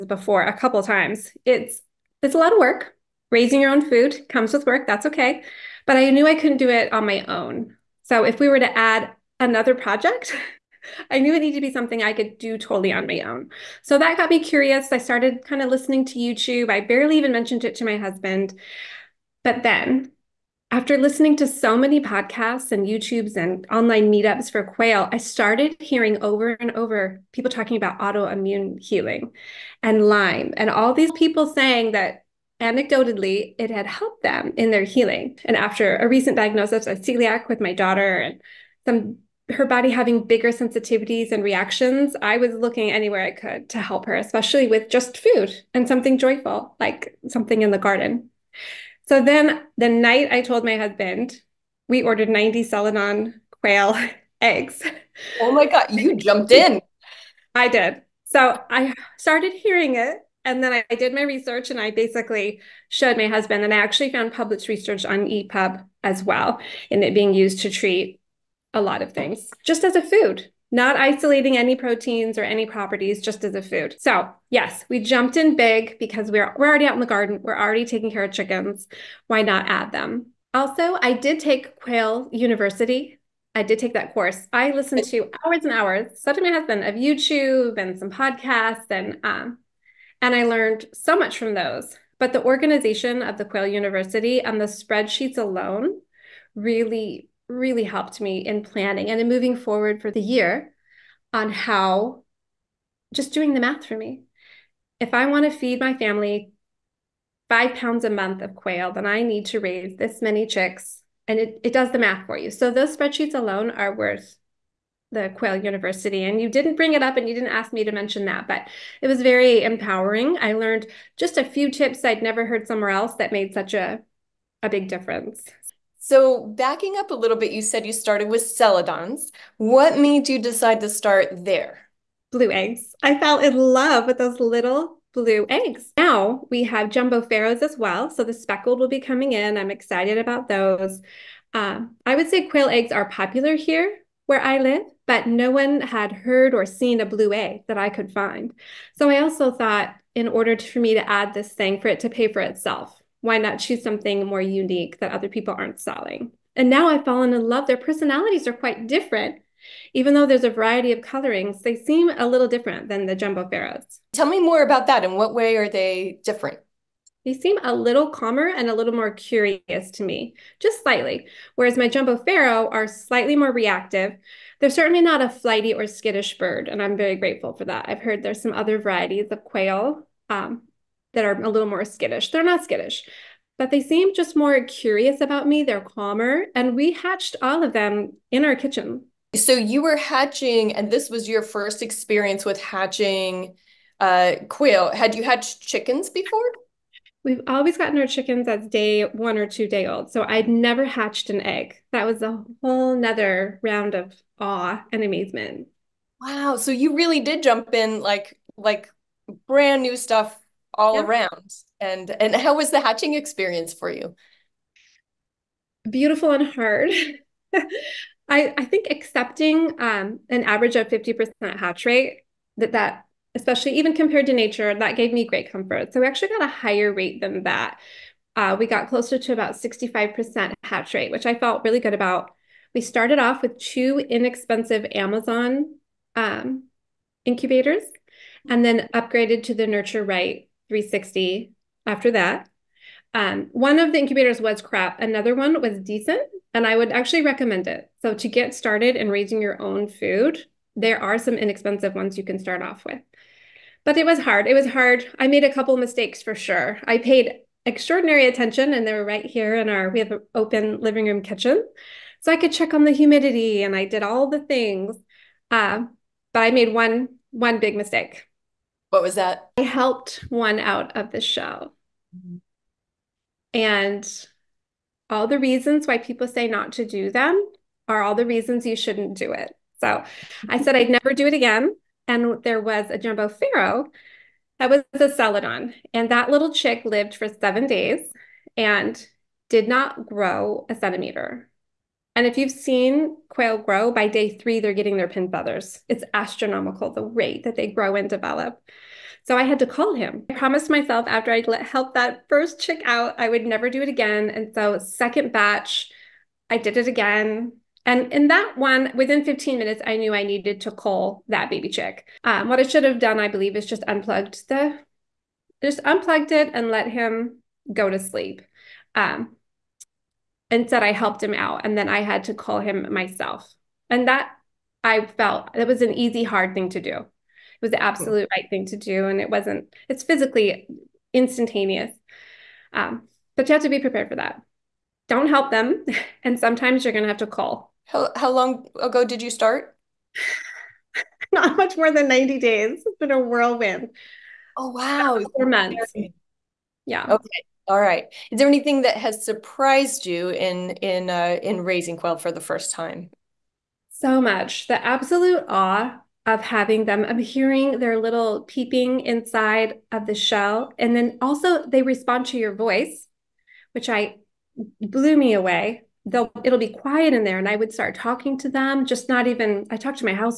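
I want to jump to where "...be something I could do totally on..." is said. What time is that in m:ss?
0:11.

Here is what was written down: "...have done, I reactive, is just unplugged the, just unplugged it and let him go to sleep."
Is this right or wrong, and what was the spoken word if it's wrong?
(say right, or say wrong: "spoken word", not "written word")
wrong: "believe", not "reactive".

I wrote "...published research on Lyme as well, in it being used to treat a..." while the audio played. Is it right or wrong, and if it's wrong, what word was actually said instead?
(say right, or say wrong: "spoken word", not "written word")
wrong: "EPUB", not "Lyme".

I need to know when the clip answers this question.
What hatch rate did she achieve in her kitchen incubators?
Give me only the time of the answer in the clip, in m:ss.
3:49.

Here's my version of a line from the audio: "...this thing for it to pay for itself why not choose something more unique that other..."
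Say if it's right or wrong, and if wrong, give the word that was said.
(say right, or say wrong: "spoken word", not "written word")
right.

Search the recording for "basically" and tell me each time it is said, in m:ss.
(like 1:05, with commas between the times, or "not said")
1:01.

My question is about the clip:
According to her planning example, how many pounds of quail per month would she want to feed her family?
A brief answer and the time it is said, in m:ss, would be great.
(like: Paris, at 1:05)
5 pounds, at 1:47.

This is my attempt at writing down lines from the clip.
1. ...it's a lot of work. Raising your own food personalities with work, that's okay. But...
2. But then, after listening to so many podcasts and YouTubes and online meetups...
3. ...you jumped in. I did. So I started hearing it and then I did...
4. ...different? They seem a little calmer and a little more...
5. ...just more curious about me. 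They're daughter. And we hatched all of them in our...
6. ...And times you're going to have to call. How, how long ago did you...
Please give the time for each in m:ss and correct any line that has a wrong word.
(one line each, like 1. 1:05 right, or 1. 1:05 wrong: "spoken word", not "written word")
1. 0:02 wrong: "comes", not "personalities"
2. 0:19 right
3. 0:55 right
4. 2:46 right
5. 3:04 wrong: "calmer", not "daughter"
6. 5:36 wrong: "sometimes", not "times".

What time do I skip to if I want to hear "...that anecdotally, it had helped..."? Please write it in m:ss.
0:31.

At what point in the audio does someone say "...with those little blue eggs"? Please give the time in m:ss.
2:14.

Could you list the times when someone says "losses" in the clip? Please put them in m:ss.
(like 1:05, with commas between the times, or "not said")
not said.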